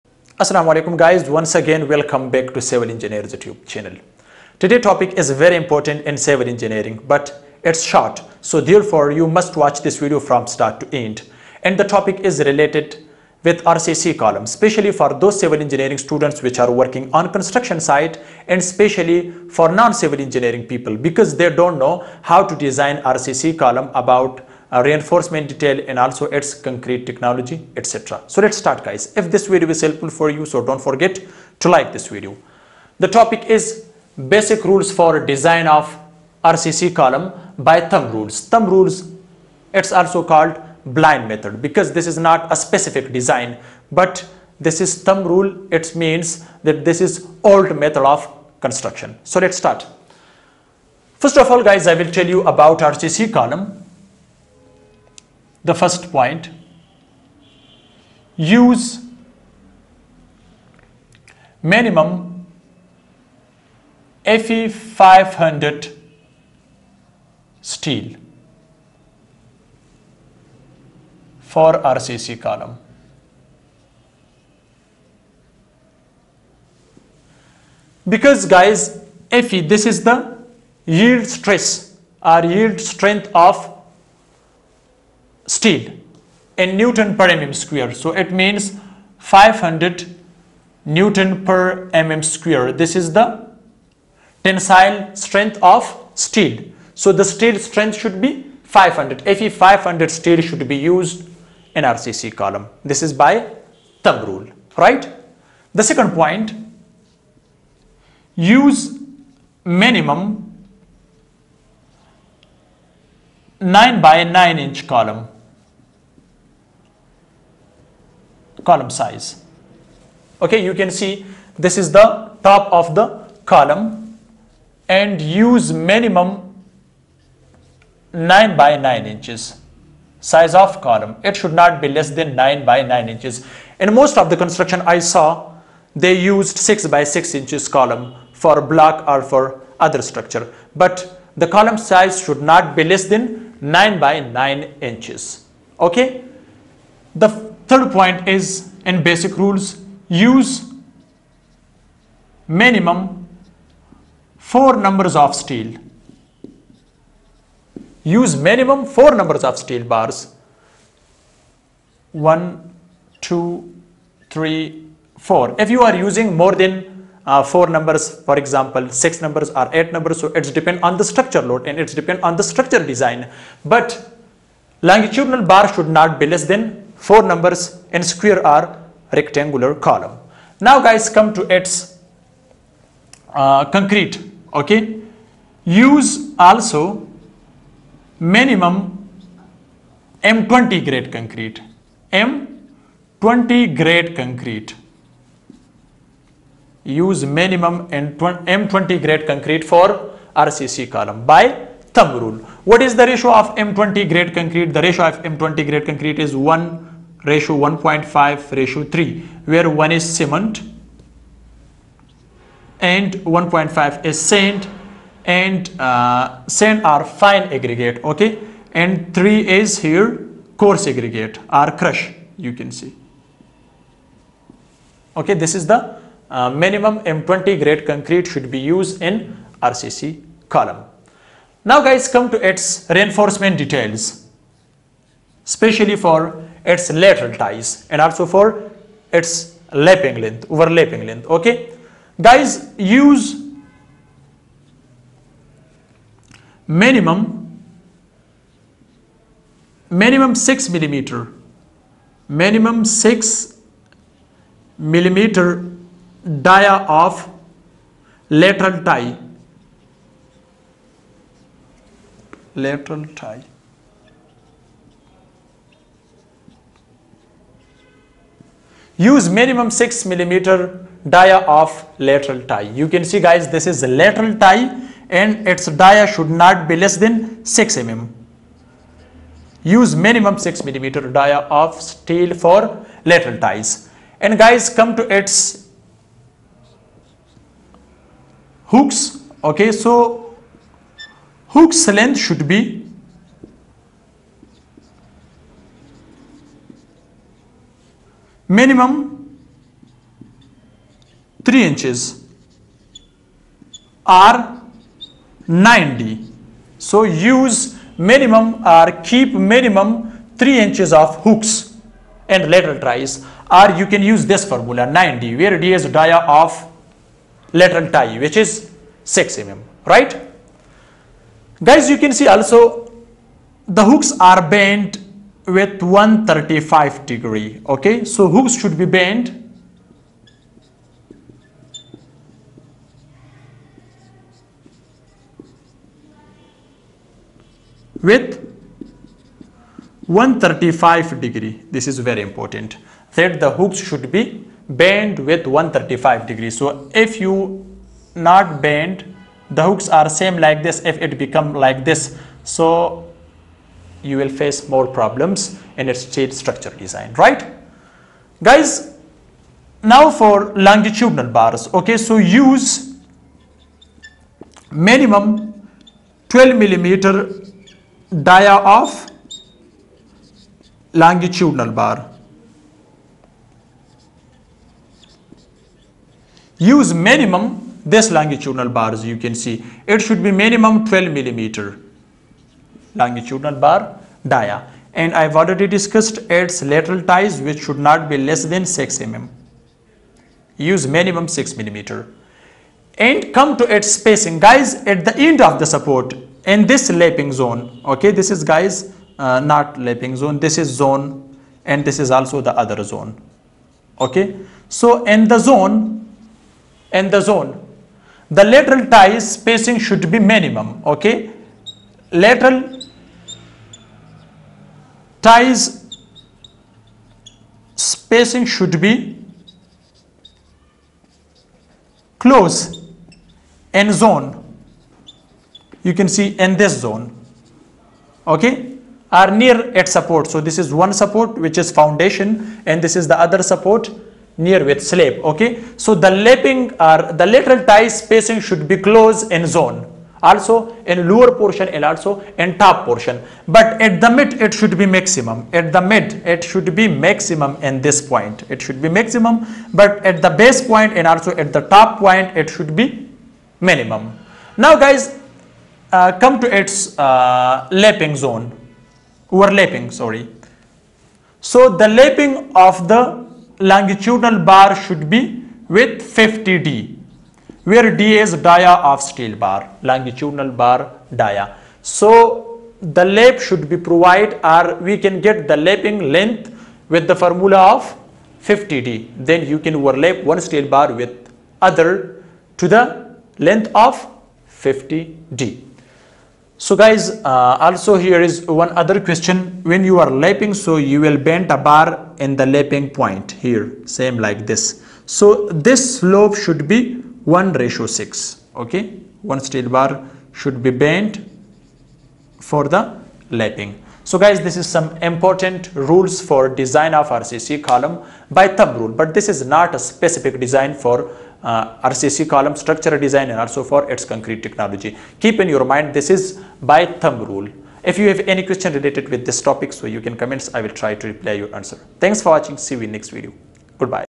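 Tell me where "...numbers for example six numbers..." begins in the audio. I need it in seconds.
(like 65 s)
167 s.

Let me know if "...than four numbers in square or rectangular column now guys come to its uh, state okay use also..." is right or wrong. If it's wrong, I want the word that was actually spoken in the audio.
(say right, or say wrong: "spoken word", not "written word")
wrong: "concrete", not "state".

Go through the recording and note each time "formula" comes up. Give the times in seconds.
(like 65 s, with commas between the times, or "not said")
314 s, 477 s.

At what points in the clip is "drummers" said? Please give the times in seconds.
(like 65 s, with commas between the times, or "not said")
not said.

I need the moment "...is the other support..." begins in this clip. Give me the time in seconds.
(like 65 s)
432 s.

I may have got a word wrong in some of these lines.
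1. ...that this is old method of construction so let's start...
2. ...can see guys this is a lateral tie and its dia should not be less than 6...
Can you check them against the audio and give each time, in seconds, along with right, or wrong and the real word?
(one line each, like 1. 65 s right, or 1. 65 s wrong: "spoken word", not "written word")
1. 46 s right
2. 272 s right.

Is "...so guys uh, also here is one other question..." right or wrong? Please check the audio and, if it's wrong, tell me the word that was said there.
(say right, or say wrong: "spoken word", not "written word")
right.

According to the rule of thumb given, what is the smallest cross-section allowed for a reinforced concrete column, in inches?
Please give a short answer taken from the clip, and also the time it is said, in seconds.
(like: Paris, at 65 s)
9 by 9 inches, at 113 s.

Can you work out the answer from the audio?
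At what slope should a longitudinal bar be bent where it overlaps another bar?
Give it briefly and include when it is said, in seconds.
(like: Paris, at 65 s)
1:6, at 497 s.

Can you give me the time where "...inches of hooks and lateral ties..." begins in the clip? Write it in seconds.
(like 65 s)
310 s.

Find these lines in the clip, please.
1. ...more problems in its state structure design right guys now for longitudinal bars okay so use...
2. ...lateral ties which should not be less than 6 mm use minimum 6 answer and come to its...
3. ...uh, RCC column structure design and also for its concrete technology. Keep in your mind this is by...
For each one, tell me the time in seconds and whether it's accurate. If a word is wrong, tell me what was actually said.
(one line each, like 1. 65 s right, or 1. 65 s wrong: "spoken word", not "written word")
1. 354 s right
2. 386 s wrong: "millimeter", not "answer"
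3. 511 s right.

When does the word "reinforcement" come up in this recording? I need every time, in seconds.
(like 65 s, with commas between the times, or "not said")
24 s, 232 s.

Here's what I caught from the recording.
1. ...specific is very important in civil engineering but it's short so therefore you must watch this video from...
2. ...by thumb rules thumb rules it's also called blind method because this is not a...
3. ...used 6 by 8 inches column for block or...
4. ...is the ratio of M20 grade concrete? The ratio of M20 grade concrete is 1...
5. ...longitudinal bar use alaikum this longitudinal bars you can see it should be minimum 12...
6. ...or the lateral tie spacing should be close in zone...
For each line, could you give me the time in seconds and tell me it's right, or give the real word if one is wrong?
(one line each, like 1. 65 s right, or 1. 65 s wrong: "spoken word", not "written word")
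1. 4 s wrong: "topic", not "specific"
2. 37 s right
3. 136 s wrong: "6", not "8"
4. 202 s right
5. 371 s wrong: "minimum", not "alaikum"
6. 436 s right.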